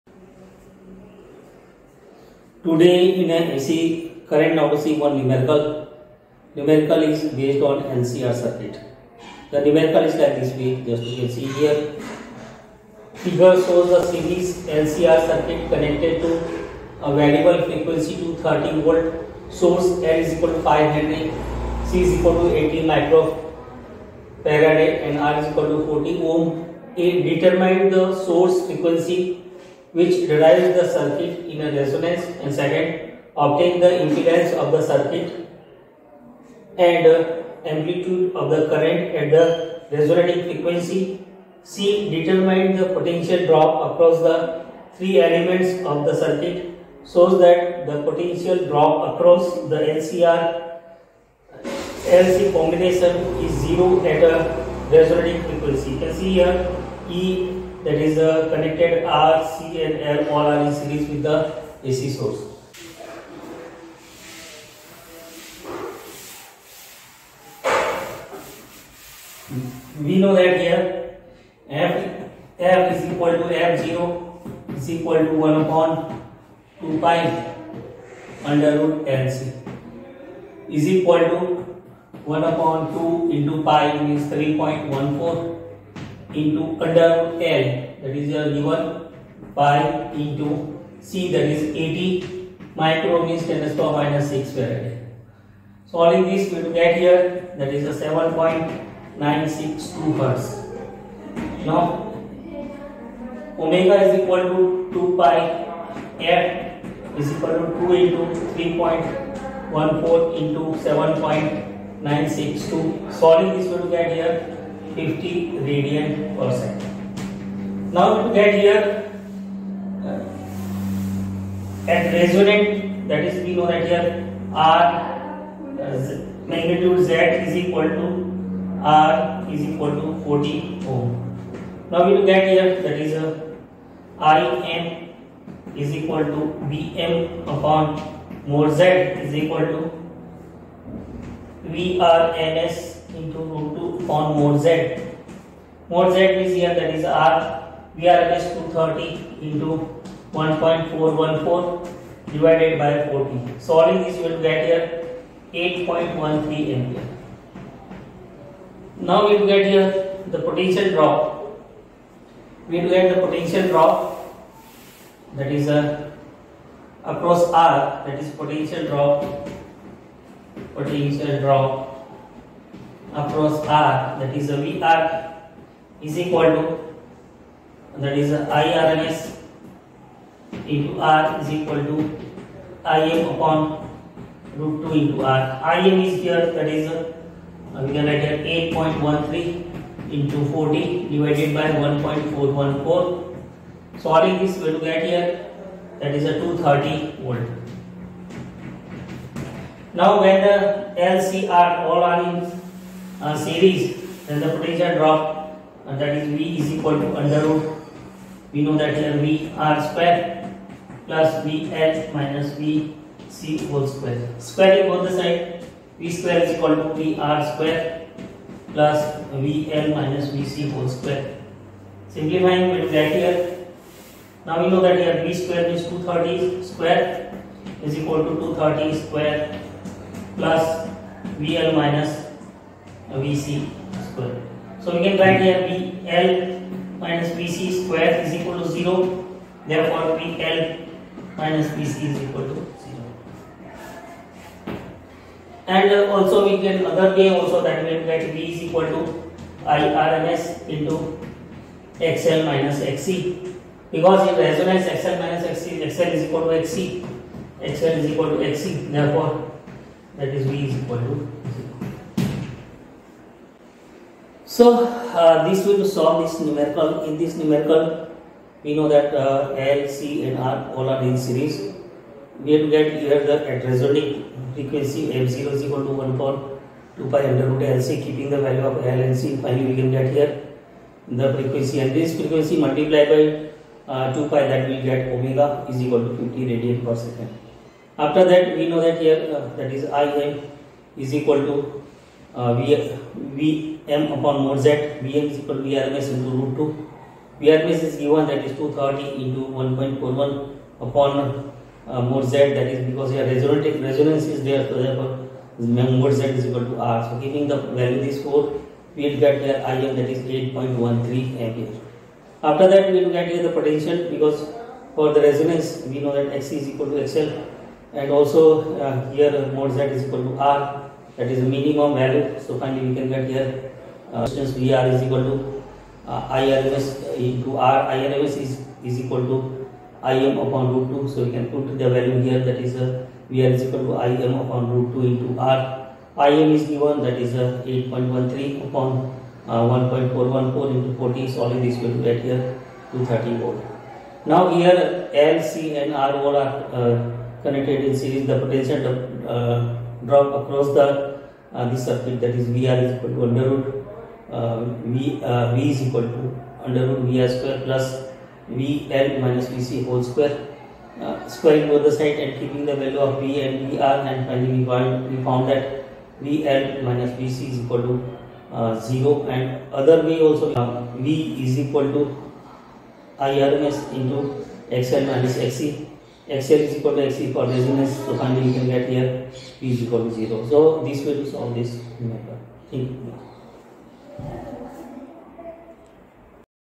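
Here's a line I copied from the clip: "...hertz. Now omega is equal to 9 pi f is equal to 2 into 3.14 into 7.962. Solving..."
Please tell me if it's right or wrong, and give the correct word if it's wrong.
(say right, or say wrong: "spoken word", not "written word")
wrong: "2", not "9".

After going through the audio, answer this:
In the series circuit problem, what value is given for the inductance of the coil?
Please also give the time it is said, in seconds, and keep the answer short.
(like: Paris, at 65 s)
5 henry, at 20 s.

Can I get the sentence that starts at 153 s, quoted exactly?
Solving this, you will get here 8.13 ampere.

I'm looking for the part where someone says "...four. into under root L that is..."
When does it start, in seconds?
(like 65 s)
85 s.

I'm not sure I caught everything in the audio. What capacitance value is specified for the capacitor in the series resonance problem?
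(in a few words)
80 microfarad.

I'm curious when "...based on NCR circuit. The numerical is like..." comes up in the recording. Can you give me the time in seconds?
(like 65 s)
7 s.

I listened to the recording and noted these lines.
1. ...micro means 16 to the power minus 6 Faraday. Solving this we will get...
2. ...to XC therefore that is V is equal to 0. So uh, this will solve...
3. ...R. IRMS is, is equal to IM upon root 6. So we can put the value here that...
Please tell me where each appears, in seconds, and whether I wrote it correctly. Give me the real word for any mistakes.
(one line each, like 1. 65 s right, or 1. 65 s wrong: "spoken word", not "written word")
1. 92 s wrong: "10", not "16"
2. 258 s right
3. 327 s wrong: "2", not "6".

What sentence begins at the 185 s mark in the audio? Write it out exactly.
IM is here that is a, uh, we can write here 8.13 into 40 divided by 1.414.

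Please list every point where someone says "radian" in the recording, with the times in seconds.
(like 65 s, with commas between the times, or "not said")
286 s.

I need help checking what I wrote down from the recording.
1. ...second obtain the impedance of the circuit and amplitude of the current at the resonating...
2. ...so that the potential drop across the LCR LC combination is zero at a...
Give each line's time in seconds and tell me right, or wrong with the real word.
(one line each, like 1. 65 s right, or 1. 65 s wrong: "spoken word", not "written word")
1. 32 s right
2. 47 s right.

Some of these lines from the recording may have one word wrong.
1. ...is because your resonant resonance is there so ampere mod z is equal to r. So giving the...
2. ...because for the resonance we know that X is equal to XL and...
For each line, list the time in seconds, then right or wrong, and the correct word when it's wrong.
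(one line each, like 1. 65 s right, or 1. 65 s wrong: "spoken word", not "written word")
1. 302 s wrong: "therefore", not "ampere"
2. 314 s right.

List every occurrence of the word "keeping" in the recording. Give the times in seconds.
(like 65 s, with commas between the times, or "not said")
278 s, 362 s.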